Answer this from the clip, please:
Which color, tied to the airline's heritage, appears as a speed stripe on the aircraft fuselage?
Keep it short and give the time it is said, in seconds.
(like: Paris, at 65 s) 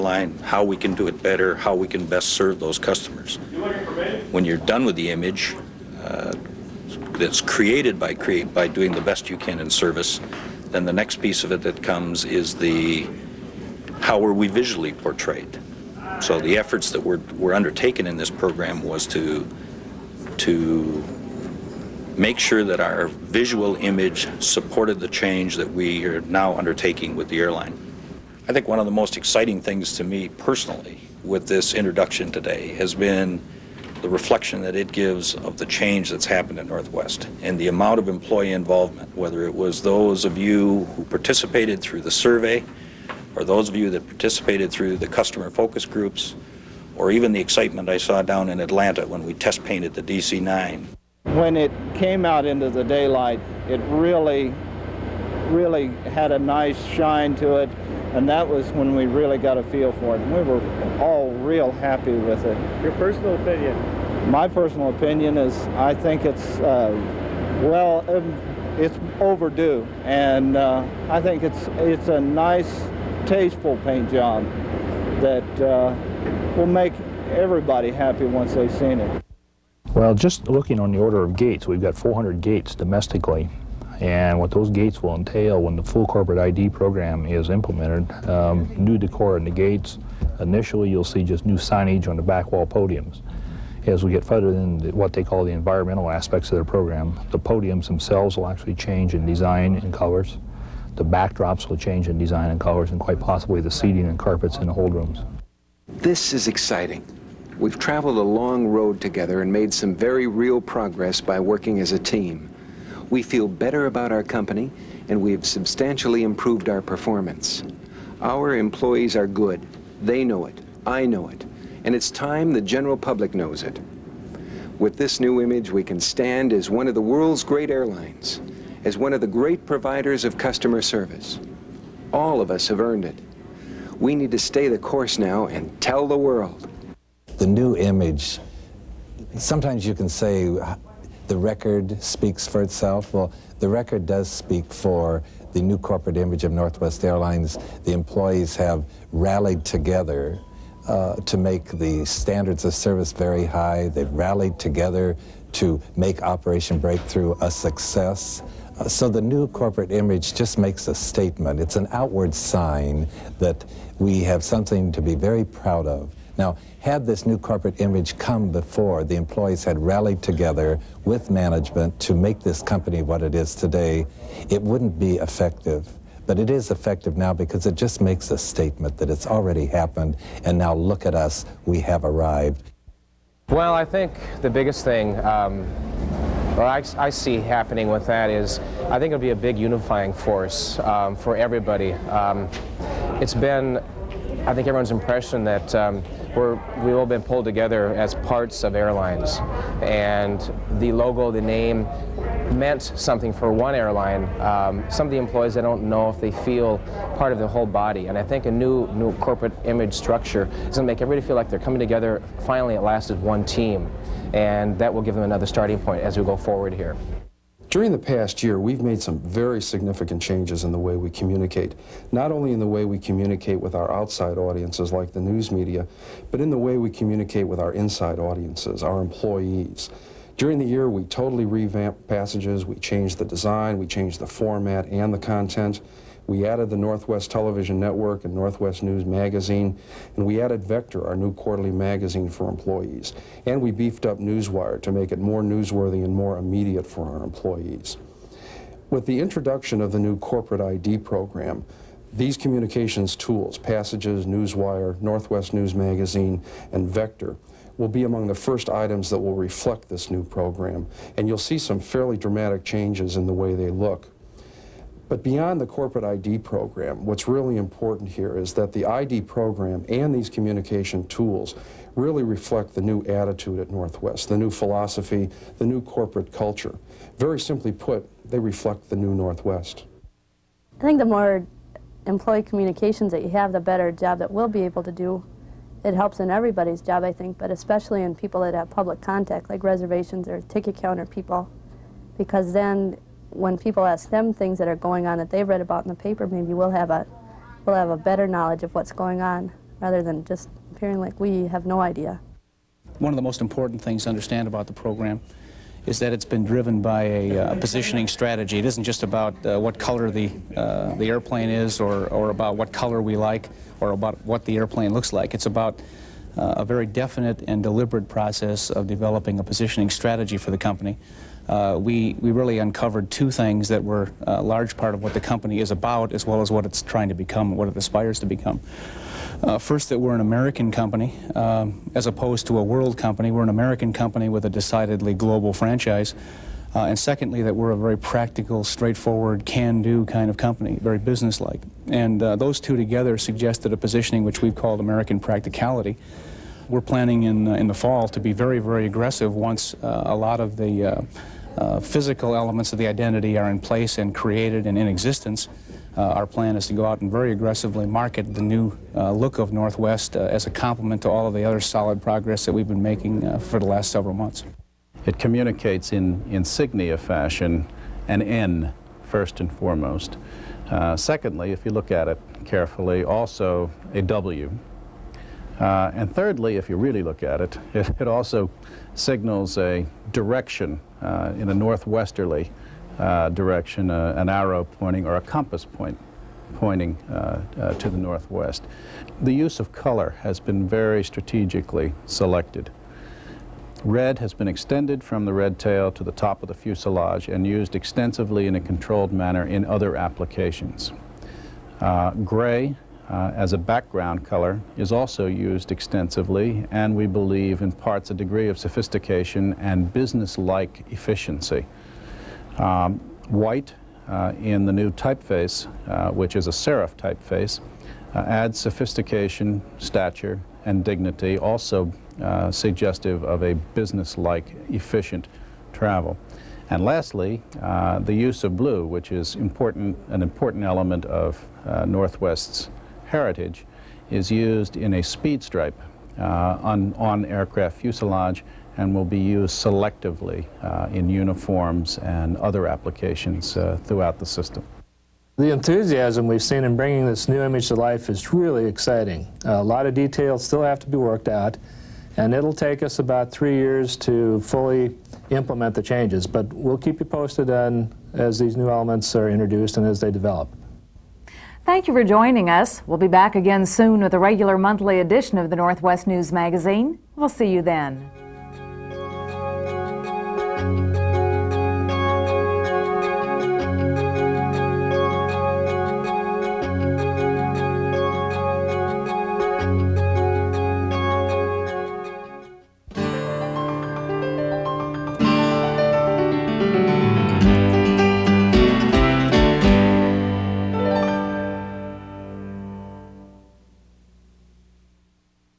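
Blue, at 428 s.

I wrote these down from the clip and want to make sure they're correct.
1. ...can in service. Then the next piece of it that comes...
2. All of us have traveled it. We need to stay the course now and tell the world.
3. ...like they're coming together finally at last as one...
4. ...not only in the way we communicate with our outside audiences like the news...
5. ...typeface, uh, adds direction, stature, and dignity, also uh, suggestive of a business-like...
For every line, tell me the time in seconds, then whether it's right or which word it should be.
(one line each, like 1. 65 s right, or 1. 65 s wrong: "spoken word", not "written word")
1. 9 s right
2. 132 s wrong: "earned", not "traveled"
3. 211 s right
4. 222 s right
5. 416 s wrong: "sophistication", not "direction".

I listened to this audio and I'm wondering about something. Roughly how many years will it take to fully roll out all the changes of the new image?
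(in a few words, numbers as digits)
3.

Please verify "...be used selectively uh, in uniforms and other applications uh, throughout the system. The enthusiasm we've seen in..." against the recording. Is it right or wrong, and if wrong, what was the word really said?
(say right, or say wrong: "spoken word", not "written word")
right.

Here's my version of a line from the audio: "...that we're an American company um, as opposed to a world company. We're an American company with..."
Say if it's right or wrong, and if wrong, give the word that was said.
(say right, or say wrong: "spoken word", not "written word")
right.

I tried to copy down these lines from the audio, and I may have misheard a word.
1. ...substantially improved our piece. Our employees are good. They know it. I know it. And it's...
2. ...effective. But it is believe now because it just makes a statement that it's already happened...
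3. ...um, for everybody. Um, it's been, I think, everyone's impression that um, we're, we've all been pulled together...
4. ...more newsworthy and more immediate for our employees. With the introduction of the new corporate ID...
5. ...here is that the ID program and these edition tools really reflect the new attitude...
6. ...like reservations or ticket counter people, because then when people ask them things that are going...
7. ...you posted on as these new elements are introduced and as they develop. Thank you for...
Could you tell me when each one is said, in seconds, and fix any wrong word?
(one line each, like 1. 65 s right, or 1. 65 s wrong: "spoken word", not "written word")
1. 115 s wrong: "performance", not "piece"
2. 175 s wrong: "effective", not "believe"
3. 190 s right
4. 245 s right
5. 268 s wrong: "communication", not "edition"
6. 289 s right
7. 456 s right.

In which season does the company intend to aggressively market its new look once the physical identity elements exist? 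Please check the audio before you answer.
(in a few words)
Fall.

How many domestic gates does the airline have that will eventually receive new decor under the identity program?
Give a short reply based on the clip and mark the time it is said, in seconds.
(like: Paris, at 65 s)
400, at 81 s.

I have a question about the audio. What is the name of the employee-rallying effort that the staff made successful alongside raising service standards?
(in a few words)
Operation Breakthrough.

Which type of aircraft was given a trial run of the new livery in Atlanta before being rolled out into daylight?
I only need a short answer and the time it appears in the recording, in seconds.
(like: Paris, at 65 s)
DC-9, at 50 s.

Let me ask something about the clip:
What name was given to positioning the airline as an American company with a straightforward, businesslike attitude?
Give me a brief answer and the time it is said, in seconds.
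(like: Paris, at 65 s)
American practicality, at 344 s.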